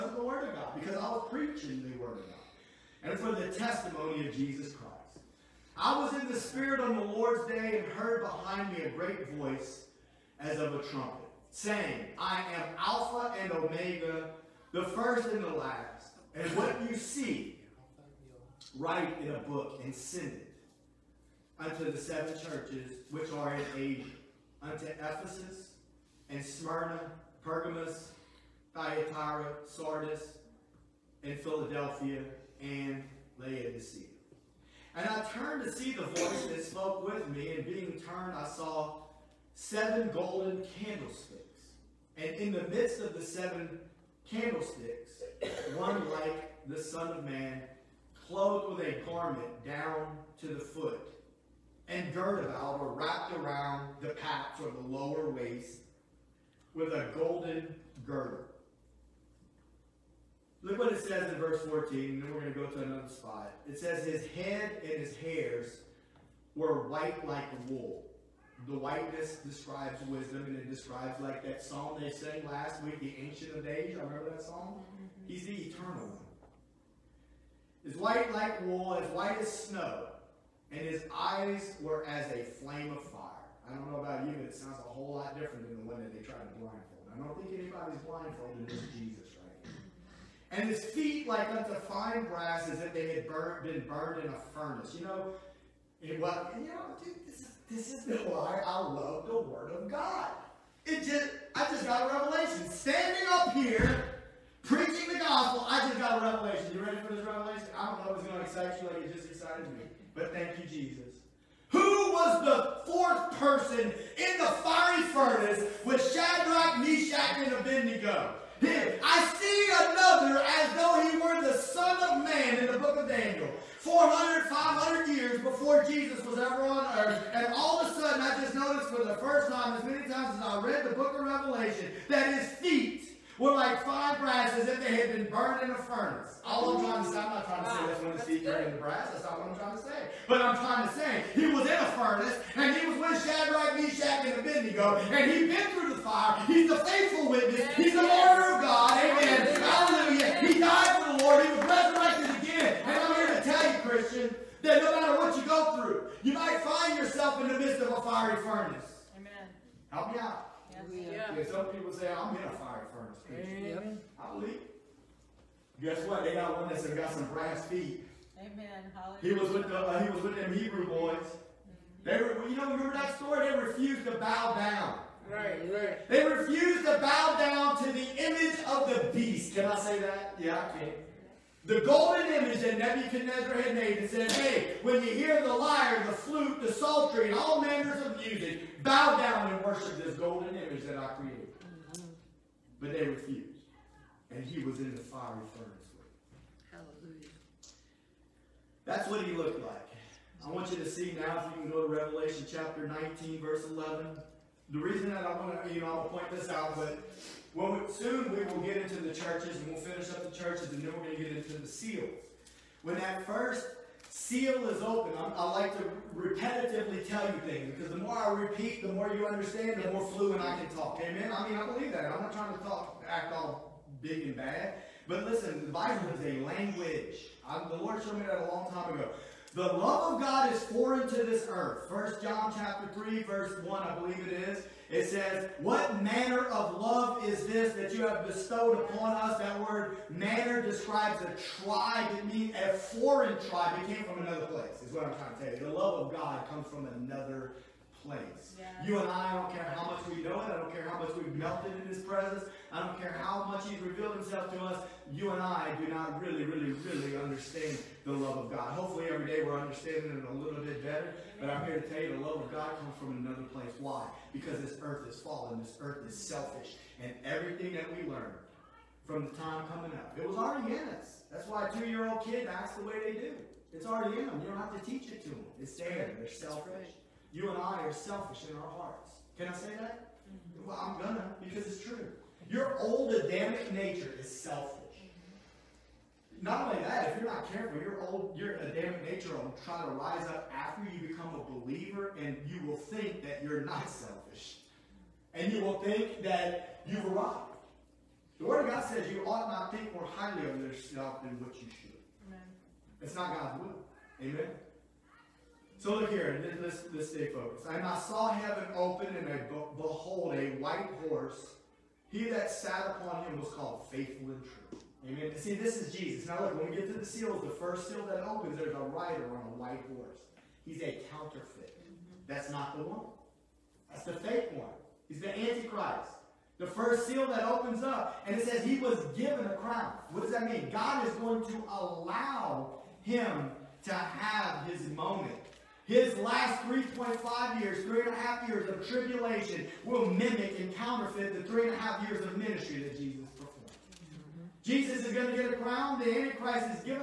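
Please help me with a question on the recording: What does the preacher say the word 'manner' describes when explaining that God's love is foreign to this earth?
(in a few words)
a tribe.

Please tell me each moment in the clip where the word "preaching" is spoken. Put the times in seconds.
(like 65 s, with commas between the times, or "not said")
1 s, 104 s.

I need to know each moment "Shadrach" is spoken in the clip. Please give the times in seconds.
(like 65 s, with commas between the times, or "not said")
116 s, 143 s.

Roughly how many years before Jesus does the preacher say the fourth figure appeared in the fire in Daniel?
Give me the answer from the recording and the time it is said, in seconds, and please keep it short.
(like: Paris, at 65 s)
400, 500 years, at 123 s.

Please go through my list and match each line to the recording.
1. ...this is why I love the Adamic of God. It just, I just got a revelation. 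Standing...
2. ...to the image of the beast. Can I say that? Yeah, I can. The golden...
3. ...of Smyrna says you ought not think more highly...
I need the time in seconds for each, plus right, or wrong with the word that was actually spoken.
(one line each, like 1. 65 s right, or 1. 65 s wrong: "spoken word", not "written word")
1. 97 s wrong: "Word", not "Adamic"
2. 177 s right
3. 298 s wrong: "God", not "Smyrna".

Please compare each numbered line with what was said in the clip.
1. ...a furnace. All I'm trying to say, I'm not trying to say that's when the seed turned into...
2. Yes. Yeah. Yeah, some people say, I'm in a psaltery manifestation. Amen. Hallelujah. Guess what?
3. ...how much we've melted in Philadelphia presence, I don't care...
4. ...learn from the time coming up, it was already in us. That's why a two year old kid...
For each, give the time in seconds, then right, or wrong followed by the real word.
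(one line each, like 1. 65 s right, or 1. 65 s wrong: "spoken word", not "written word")
1. 135 s right
2. 160 s wrong: "fiery", not "psaltery"
3. 250 s wrong: "His", not "Philadelphia"
4. 268 s right.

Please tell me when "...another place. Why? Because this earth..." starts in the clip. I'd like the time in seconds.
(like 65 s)
263 s.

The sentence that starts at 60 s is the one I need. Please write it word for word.
Look what it says in verse 14, and then we're going to go to another spot.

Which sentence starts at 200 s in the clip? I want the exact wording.
I want you to see now, if you can go to Revelation chapter 19, verse 11.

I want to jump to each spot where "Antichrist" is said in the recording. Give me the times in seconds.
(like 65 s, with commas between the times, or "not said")
325 s, 346 s.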